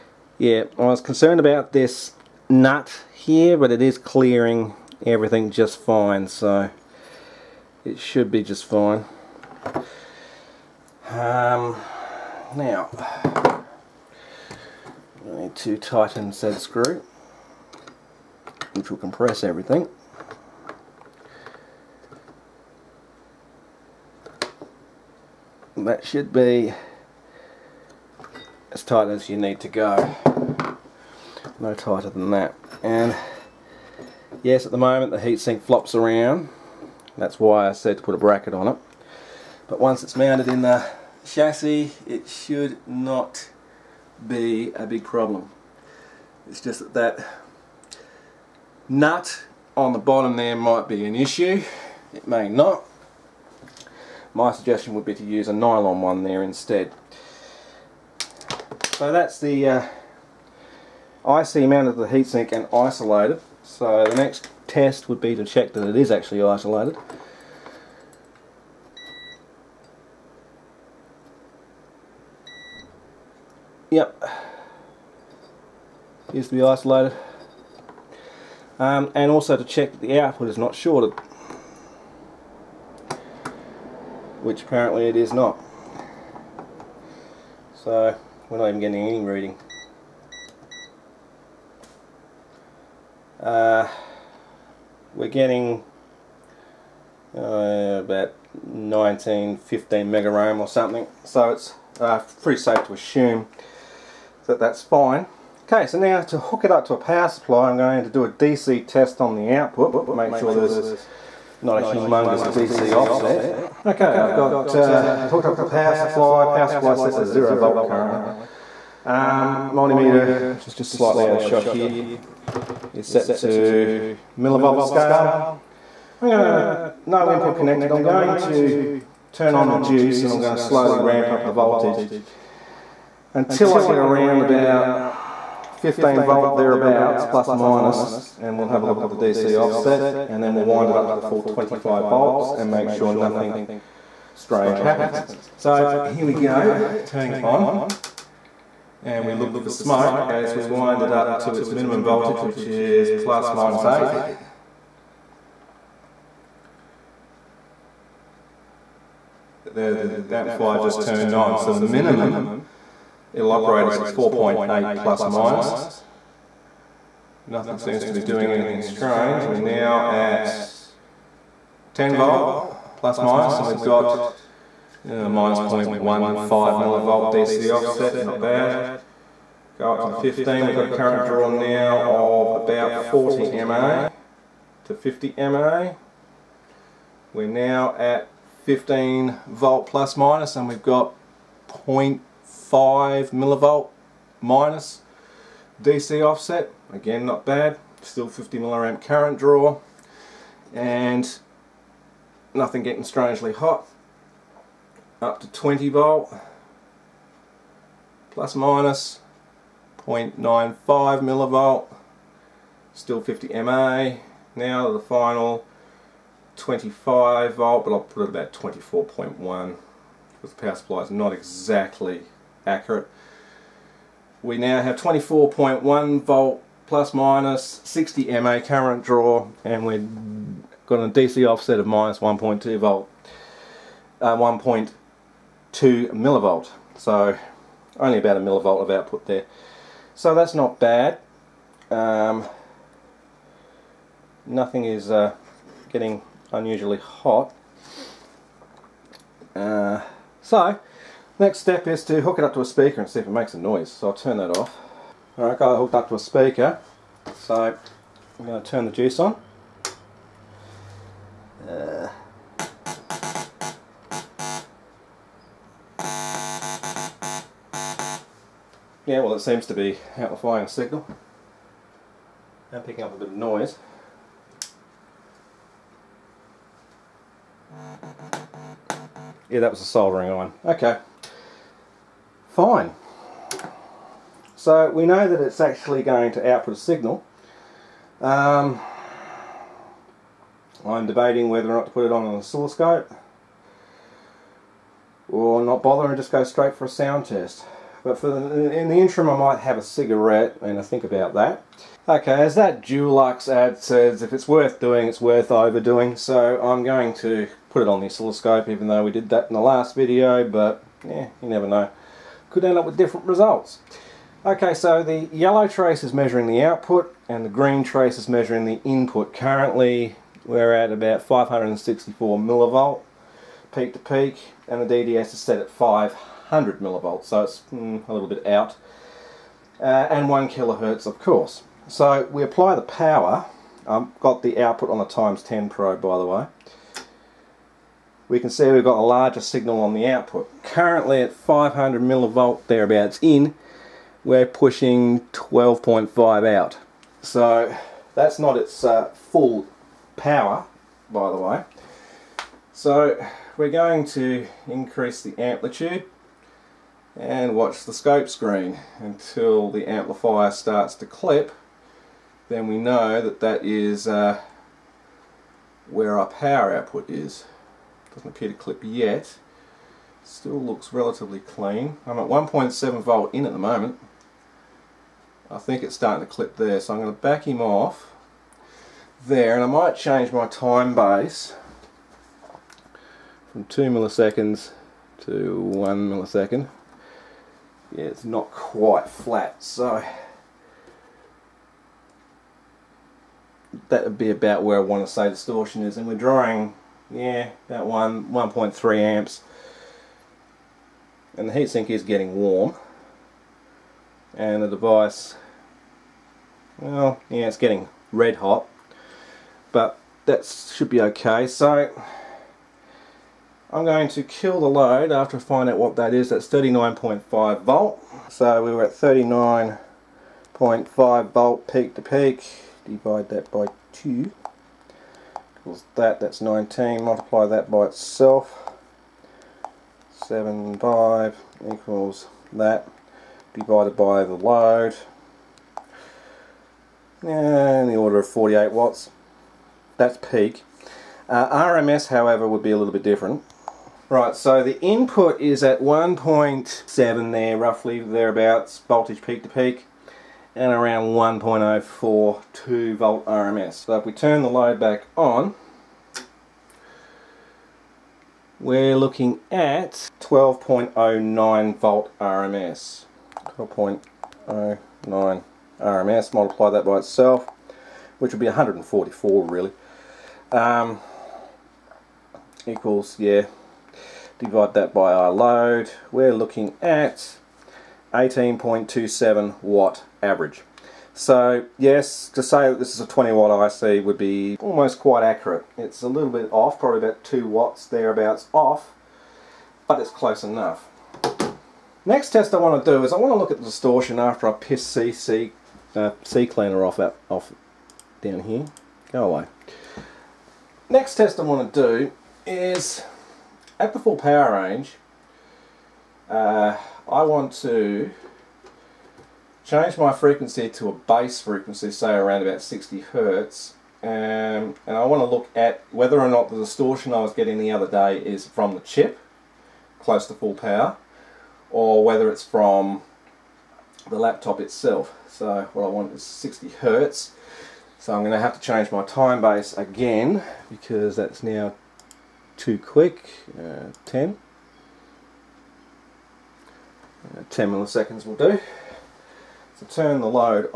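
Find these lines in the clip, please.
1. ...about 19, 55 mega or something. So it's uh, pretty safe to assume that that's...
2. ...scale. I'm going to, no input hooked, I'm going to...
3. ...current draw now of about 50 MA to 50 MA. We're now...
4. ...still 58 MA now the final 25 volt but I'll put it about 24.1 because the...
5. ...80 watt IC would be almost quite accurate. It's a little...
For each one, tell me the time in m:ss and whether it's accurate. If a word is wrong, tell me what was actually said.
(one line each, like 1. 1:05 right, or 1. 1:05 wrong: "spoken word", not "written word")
1. 1:38 wrong: "15", not "55"
2. 2:04 wrong: "connected", not "hooked"
3. 3:00 wrong: "40", not "50"
4. 3:32 wrong: "50", not "58"
5. 8:03 wrong: "20", not "80".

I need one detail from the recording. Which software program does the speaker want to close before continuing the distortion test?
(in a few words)
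CCleaner.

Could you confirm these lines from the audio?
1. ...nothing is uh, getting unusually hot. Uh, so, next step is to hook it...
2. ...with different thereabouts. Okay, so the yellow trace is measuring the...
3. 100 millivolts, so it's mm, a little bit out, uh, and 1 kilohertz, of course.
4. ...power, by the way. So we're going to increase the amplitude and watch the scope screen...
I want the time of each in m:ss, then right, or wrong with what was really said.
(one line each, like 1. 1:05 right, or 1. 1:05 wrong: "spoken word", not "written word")
1. 4:04 right
2. 5:12 wrong: "results", not "thereabouts"
3. 5:26 right
4. 5:50 right.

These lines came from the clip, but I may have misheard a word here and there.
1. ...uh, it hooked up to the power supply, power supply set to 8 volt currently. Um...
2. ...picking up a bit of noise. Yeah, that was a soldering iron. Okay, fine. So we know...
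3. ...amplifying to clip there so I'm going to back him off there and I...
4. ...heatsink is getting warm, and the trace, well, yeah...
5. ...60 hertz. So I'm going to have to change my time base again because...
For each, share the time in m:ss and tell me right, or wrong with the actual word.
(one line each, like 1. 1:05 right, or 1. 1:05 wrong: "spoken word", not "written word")
1. 1:54 wrong: "0", not "8"
2. 4:32 right
3. 6:15 wrong: "starting", not "amplifying"
4. 6:41 wrong: "device", not "trace"
5. 8:46 right.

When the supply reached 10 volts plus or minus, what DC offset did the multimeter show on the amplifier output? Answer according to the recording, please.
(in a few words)
-0.15 millivolts.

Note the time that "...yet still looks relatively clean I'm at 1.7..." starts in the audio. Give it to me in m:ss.
6:08.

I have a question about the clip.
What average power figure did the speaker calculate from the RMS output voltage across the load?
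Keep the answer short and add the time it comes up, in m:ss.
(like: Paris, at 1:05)
18.27 watts, at 7:58.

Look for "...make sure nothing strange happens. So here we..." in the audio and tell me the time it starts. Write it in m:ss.
2:22.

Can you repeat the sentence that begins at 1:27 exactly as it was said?
So we're not even getting any reading.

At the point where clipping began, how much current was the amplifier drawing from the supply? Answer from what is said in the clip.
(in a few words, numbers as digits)
1.3 amps.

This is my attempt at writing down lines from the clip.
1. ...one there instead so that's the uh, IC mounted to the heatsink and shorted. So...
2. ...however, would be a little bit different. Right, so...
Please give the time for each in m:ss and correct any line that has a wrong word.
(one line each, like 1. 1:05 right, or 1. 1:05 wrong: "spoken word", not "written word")
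1. 0:56 wrong: "isolated", not "shorted"
2. 7:22 right.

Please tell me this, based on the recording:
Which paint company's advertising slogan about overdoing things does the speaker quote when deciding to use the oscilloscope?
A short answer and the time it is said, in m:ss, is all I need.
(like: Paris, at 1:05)
Dulux, at 5:02.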